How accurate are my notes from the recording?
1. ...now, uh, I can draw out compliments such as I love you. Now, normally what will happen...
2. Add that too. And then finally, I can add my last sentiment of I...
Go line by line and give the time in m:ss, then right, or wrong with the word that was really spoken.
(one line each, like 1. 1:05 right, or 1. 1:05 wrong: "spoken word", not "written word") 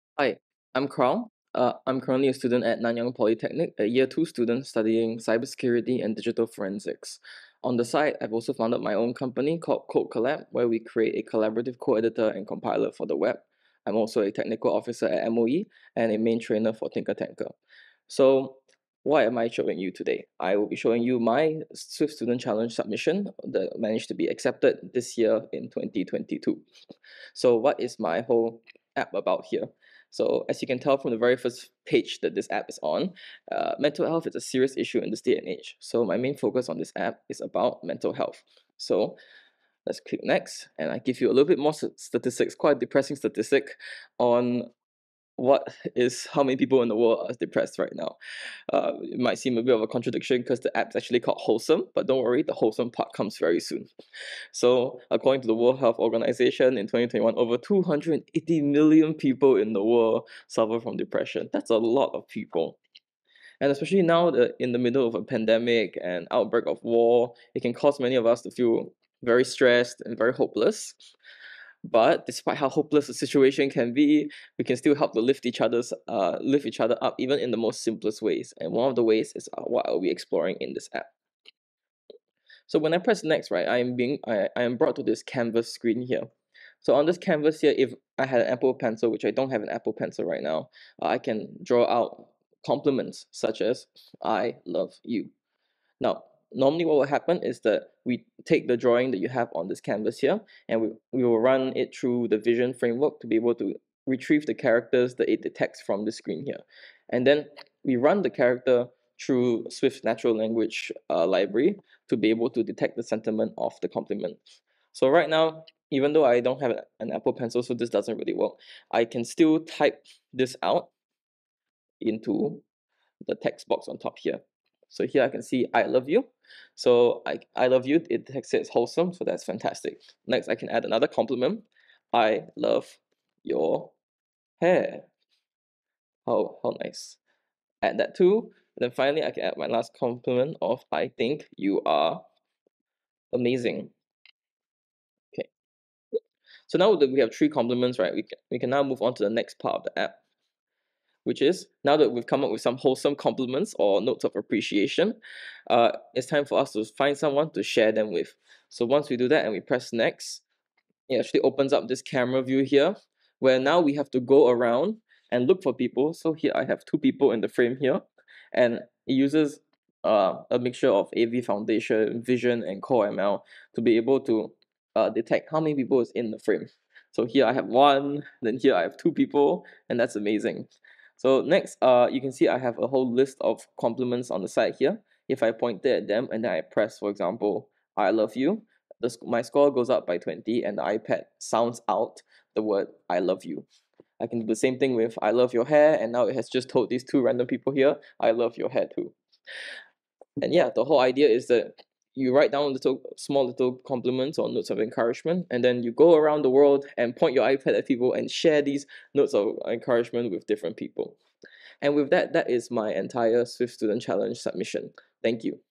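1. 1:30 right
2. 2:17 wrong: "compliment", not "sentiment".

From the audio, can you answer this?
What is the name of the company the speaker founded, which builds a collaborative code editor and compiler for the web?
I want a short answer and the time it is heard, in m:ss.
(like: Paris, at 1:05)
Code Collab, at 0:09.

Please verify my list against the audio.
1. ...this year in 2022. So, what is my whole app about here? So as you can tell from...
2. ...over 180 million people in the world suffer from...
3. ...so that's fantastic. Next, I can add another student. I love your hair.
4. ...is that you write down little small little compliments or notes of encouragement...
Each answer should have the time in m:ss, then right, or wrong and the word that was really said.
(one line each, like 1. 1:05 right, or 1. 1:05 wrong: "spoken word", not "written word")
1. 0:24 right
2. 0:57 wrong: "280", not "180"
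3. 2:09 wrong: "compliment", not "student"
4. 3:21 right.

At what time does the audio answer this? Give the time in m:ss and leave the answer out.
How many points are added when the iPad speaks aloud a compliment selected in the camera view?
3:10.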